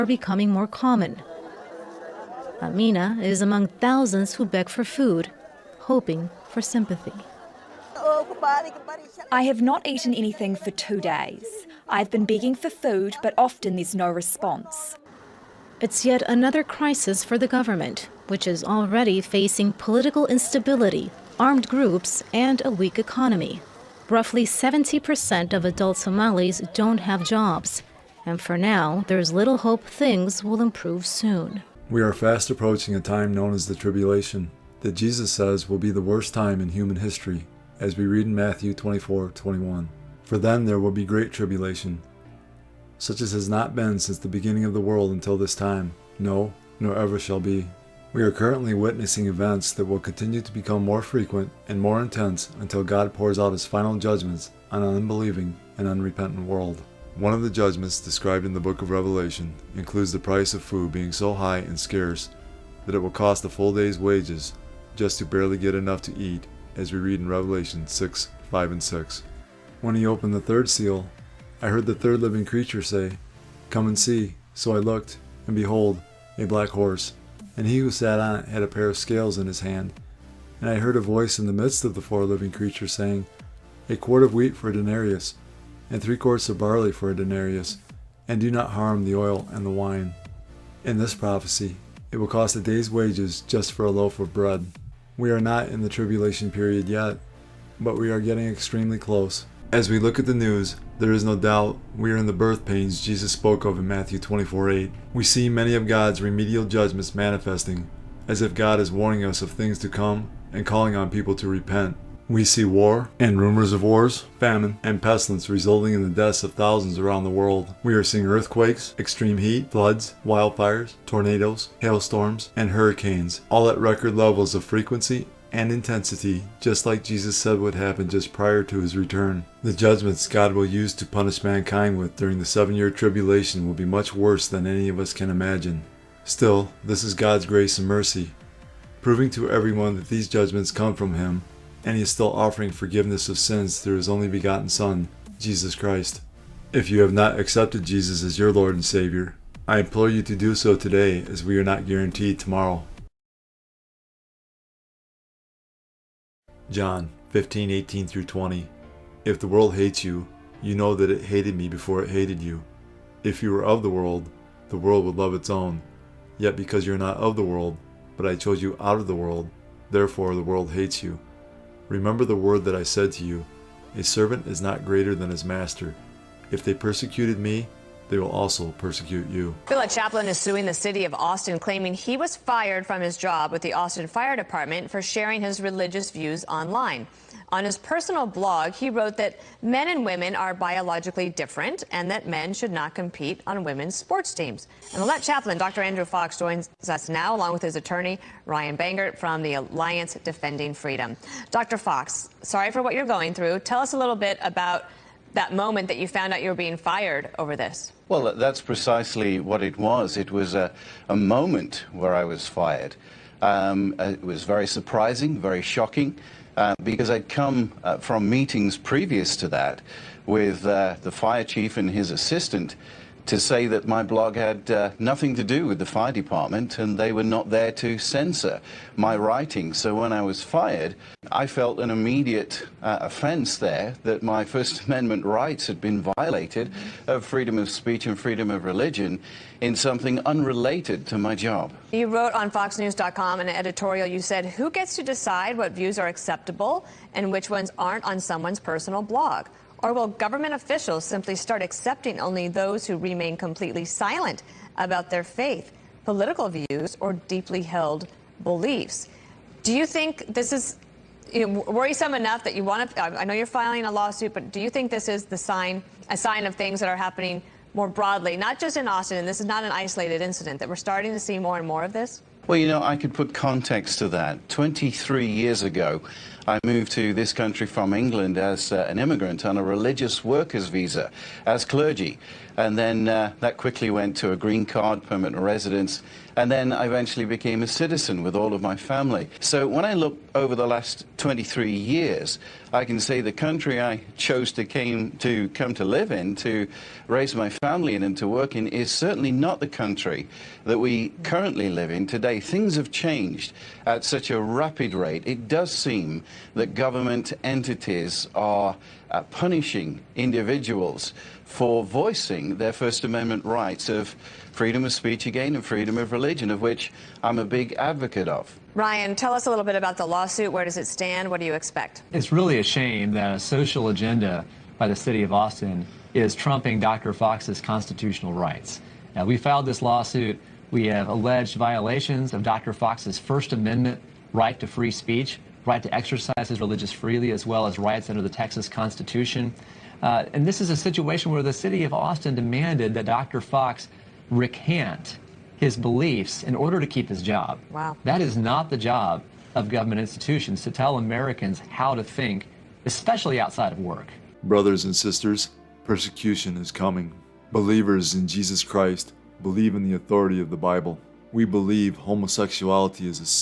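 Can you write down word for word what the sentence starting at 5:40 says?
Uh, and this is a situation where the city of Austin demanded that Dr.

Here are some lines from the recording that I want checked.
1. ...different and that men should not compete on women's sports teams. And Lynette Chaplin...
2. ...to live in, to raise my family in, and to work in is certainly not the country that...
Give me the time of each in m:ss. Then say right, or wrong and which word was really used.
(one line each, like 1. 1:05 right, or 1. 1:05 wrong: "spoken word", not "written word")
1. 3:11 right
2. 4:55 right.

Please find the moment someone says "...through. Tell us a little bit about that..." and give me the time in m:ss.
3:23.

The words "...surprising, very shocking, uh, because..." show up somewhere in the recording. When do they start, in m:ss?
3:34.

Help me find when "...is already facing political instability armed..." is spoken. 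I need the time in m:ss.
0:18.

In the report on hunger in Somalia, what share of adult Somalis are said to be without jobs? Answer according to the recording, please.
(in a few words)
70%.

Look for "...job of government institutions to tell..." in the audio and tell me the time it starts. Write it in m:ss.
5:48.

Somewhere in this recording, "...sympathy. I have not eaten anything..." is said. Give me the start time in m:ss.
0:06.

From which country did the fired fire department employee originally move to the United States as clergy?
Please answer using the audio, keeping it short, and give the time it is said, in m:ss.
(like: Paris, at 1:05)
England, at 4:37.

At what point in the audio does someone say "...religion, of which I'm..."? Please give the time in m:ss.
5:16.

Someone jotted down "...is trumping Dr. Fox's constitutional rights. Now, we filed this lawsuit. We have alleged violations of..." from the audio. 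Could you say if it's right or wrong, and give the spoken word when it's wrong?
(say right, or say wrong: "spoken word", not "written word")
right.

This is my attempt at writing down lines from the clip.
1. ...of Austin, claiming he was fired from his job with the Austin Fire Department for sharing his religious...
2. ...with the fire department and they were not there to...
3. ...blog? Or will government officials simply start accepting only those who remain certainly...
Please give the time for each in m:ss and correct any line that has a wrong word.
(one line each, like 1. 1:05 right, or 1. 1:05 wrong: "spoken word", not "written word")
1. 3:01 right
2. 3:45 right
3. 4:09 wrong: "completely", not "certainly".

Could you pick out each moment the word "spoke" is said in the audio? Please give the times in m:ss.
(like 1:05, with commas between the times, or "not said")
1:43.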